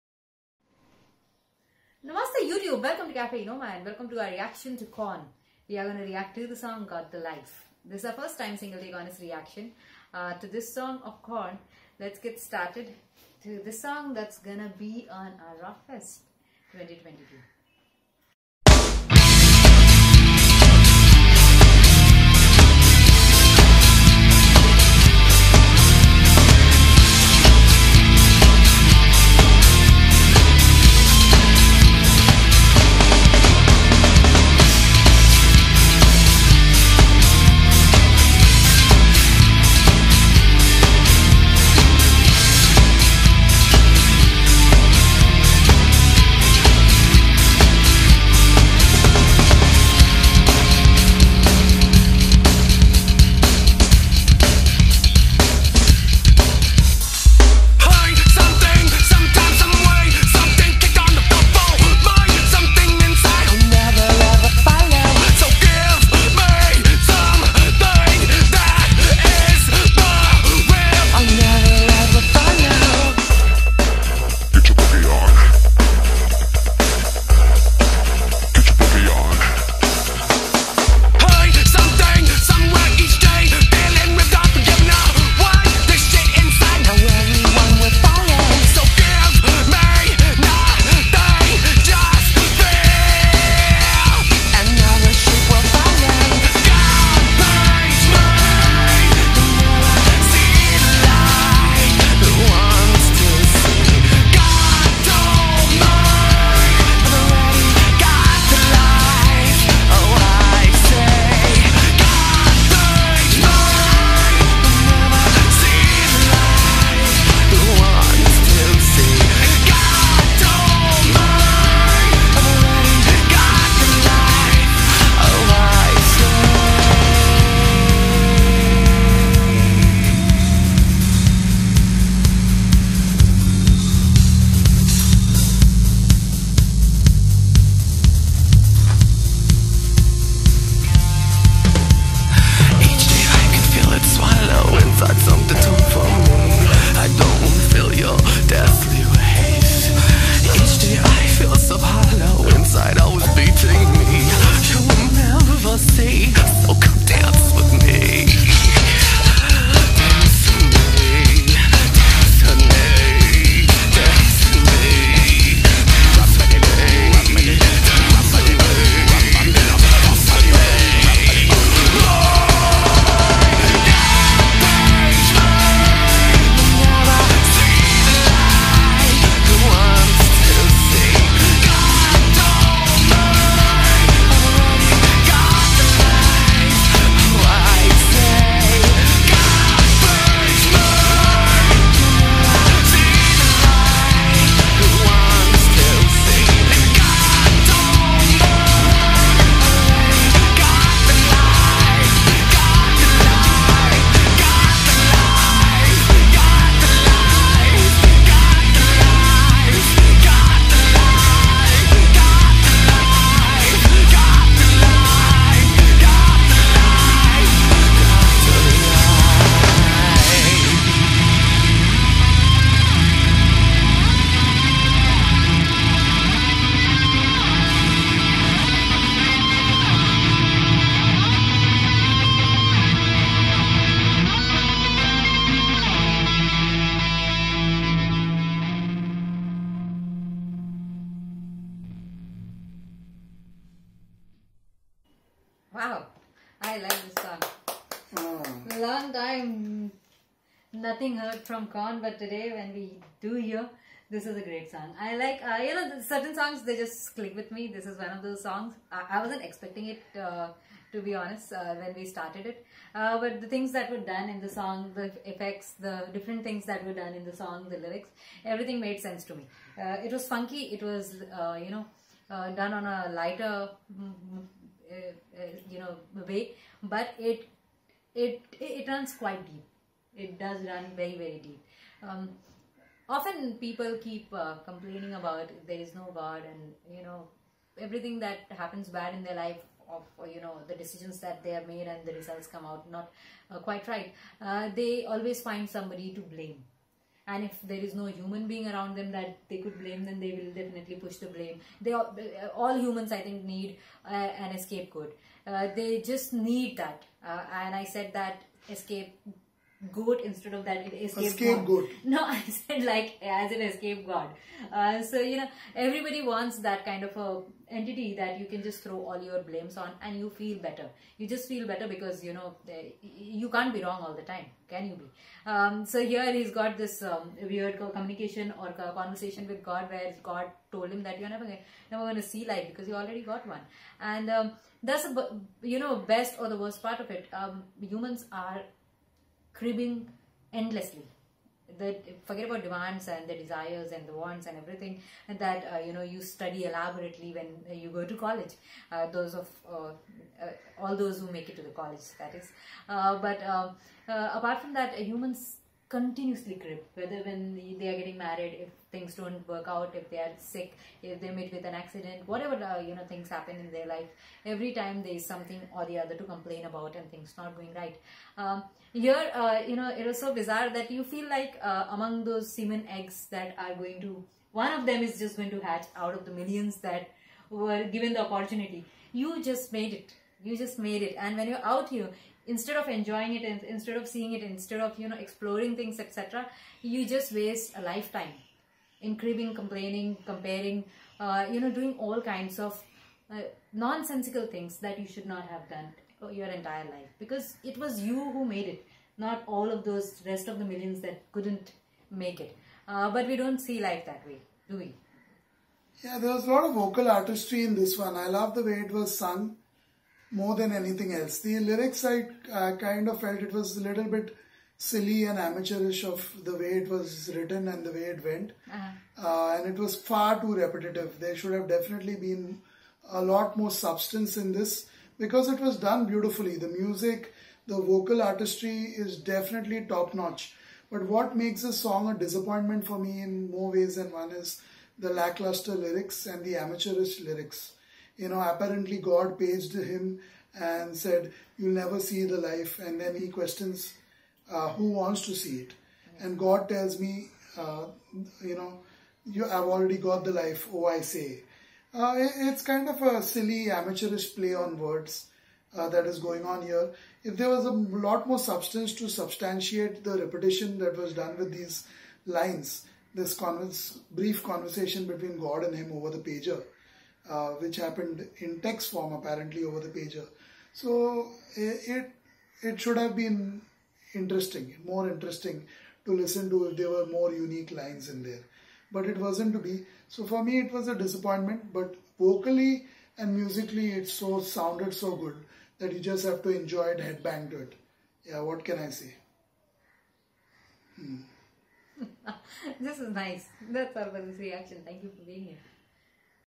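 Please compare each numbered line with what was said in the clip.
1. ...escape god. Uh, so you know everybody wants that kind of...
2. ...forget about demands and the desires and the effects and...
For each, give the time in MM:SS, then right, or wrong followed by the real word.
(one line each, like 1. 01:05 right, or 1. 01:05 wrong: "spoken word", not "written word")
1. 05:13 right
2. 05:42 wrong: "wants", not "effects".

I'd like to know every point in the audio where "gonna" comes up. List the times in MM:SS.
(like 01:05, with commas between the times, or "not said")
00:14, 05:31.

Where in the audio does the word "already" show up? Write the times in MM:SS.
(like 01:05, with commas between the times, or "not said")
05:32, 07:29.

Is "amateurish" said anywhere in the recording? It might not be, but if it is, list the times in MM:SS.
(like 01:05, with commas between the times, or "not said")
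06:55, 07:16, 07:33.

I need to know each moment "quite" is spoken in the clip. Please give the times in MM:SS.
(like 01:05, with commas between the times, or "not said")
04:39, 04:53.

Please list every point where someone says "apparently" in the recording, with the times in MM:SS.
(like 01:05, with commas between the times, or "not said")
07:18, 07:49.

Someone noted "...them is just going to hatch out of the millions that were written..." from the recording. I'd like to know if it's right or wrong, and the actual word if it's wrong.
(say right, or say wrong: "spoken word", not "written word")
wrong: "given", not "written".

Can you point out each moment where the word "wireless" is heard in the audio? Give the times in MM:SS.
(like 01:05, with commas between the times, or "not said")
not said.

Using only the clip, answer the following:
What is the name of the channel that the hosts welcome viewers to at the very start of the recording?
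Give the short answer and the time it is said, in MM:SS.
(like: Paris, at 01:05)
Cafe Noma, at 00:03.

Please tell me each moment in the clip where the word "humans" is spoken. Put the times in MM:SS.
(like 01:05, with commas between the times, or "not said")
04:58, 05:02, 05:37, 05:54.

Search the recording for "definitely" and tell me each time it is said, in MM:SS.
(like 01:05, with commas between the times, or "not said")
05:00, 07:01, 07:09.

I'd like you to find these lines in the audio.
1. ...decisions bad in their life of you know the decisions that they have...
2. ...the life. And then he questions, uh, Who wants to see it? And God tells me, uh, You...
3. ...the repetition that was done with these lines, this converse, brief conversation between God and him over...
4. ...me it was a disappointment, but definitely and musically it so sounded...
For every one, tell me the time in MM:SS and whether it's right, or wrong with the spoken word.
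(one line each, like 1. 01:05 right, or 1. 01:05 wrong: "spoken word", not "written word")
1. 04:48 wrong: "happens", not "decisions"
2. 07:22 right
3. 07:40 right
4. 08:00 wrong: "vocally", not "definitely".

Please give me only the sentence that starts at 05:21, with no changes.
You just feel better because you know eh, you can't be wrong all the time, can you be?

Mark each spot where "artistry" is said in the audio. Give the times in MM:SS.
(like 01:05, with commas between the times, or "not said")
06:47, 07:08.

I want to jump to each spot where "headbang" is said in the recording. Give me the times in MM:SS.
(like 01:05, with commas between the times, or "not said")
08:06.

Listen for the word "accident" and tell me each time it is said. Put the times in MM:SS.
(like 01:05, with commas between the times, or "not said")
06:01.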